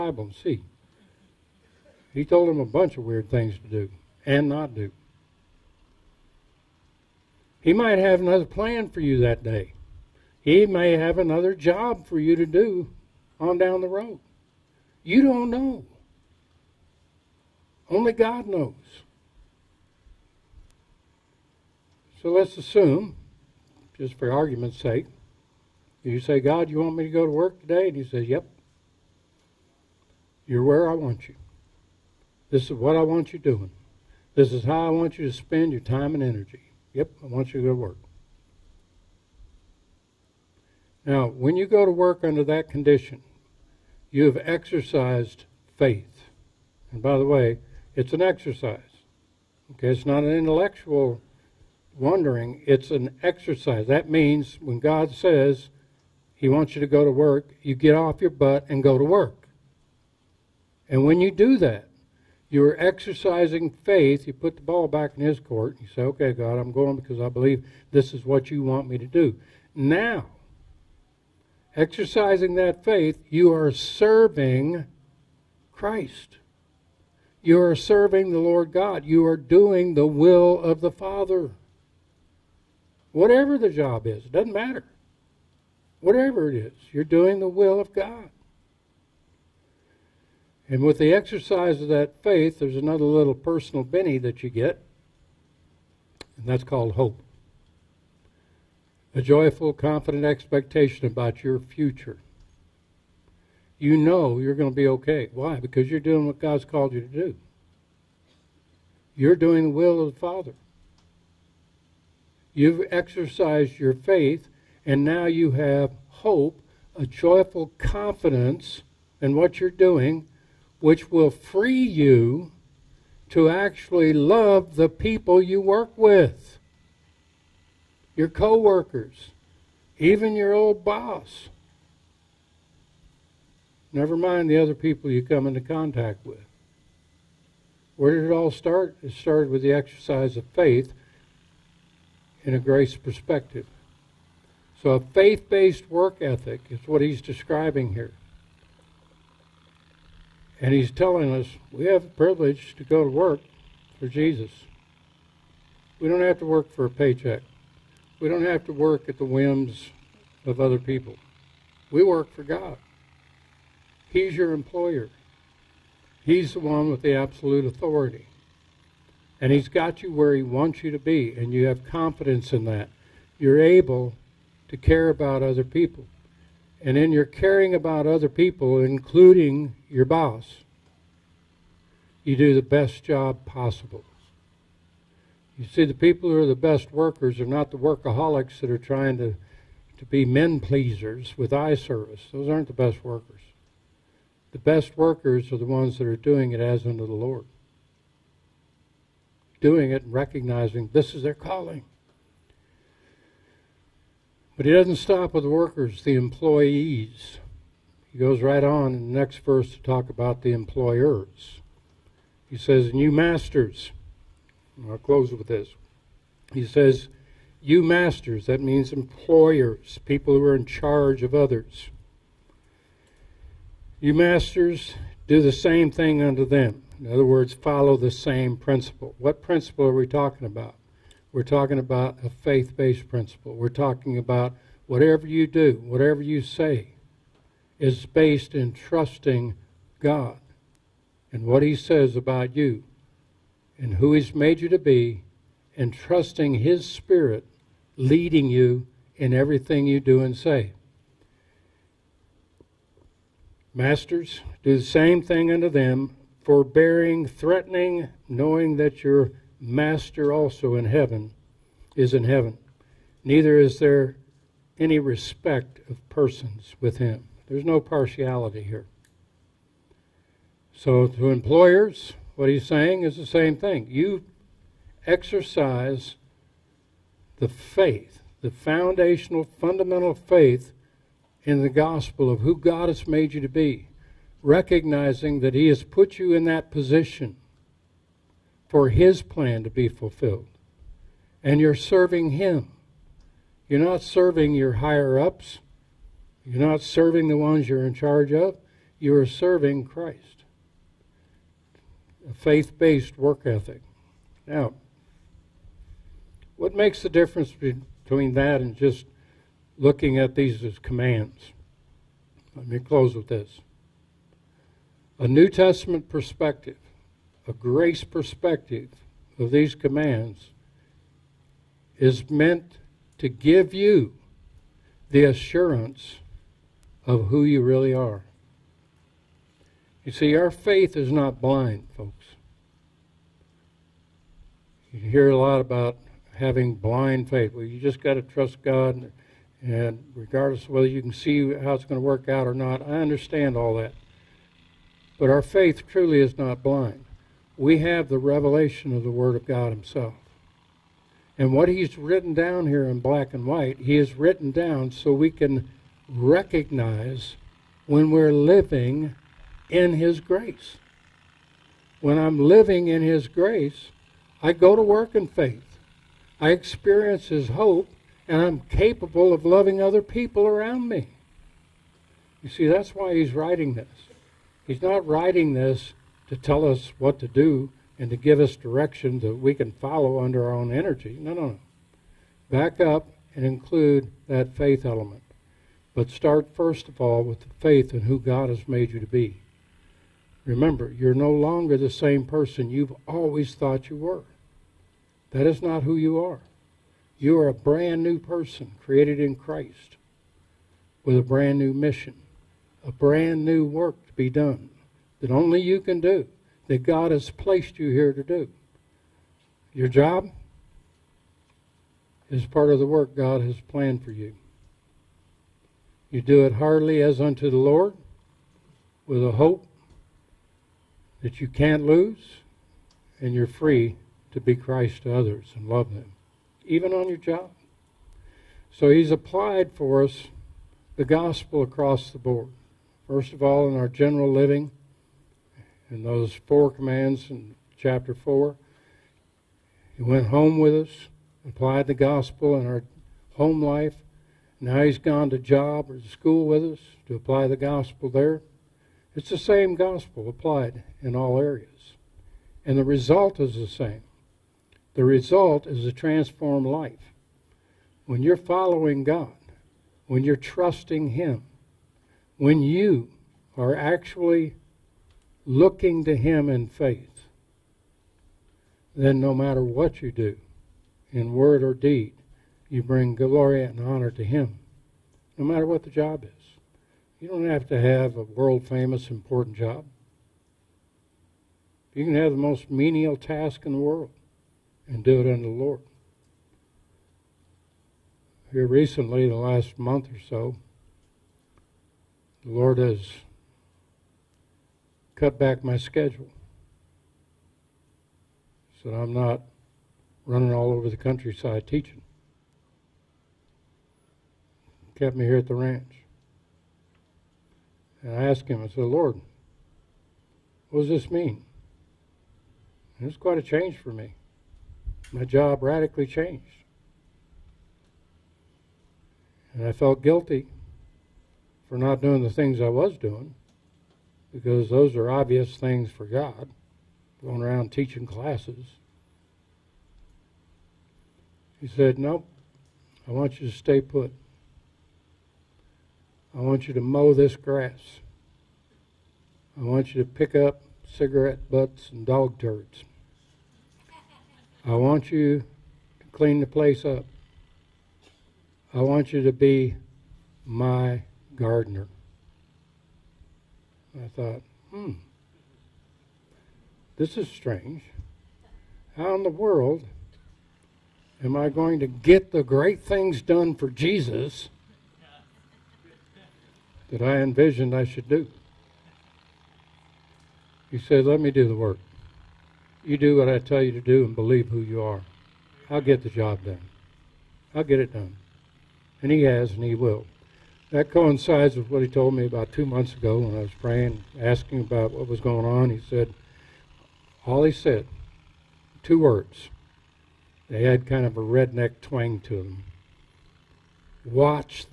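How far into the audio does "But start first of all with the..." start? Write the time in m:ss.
6:25.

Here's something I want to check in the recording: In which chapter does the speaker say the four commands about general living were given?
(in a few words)
chapter 4.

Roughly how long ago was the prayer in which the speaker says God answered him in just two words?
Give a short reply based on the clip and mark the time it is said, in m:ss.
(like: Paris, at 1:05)
about two months, at 9:42.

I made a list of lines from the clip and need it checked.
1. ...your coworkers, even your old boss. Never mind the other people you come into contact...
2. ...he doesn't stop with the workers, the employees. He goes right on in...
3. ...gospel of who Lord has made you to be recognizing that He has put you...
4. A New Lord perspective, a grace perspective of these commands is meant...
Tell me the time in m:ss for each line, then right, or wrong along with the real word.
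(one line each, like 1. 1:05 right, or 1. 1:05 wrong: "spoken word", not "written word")
1. 2:08 right
2. 3:24 right
3. 4:41 wrong: "God", not "Lord"
4. 5:15 wrong: "Testament", not "Lord".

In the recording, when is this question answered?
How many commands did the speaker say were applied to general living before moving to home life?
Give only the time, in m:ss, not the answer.
7:16.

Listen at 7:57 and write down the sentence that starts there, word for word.
You don't have to have a world famous, important job.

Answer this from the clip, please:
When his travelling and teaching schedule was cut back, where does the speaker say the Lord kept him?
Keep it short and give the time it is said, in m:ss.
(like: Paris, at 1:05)
the ranch, at 8:25.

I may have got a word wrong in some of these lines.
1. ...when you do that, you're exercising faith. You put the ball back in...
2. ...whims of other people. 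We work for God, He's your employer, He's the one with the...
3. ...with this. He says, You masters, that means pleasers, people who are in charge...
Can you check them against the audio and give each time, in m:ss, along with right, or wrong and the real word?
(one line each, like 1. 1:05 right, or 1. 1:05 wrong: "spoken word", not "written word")
1. 1:01 right
2. 2:39 right
3. 3:35 wrong: "employers", not "pleasers".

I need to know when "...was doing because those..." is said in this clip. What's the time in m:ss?
8:42.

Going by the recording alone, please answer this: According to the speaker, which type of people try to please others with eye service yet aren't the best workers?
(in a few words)
workaholics.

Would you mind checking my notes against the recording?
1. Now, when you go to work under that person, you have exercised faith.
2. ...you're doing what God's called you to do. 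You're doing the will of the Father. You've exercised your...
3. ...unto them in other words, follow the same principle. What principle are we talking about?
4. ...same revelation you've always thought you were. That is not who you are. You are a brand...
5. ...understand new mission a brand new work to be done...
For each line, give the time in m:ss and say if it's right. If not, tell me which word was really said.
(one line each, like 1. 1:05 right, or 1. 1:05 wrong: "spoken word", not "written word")
1. 0:41 wrong: "condition", not "person"
2. 1:45 right
3. 3:46 right
4. 6:31 wrong: "person", not "revelation"
5. 6:41 wrong: "brand", not "understand".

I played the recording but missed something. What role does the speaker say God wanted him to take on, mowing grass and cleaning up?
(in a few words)
gardener.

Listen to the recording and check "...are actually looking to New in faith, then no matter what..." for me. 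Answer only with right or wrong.
wrong.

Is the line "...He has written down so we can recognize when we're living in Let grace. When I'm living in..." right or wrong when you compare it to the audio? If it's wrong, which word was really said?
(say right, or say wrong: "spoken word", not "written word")
wrong: "His", not "Let".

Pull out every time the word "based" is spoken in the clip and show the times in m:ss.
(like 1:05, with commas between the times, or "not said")
2:25, 3:52, 3:58, 5:02.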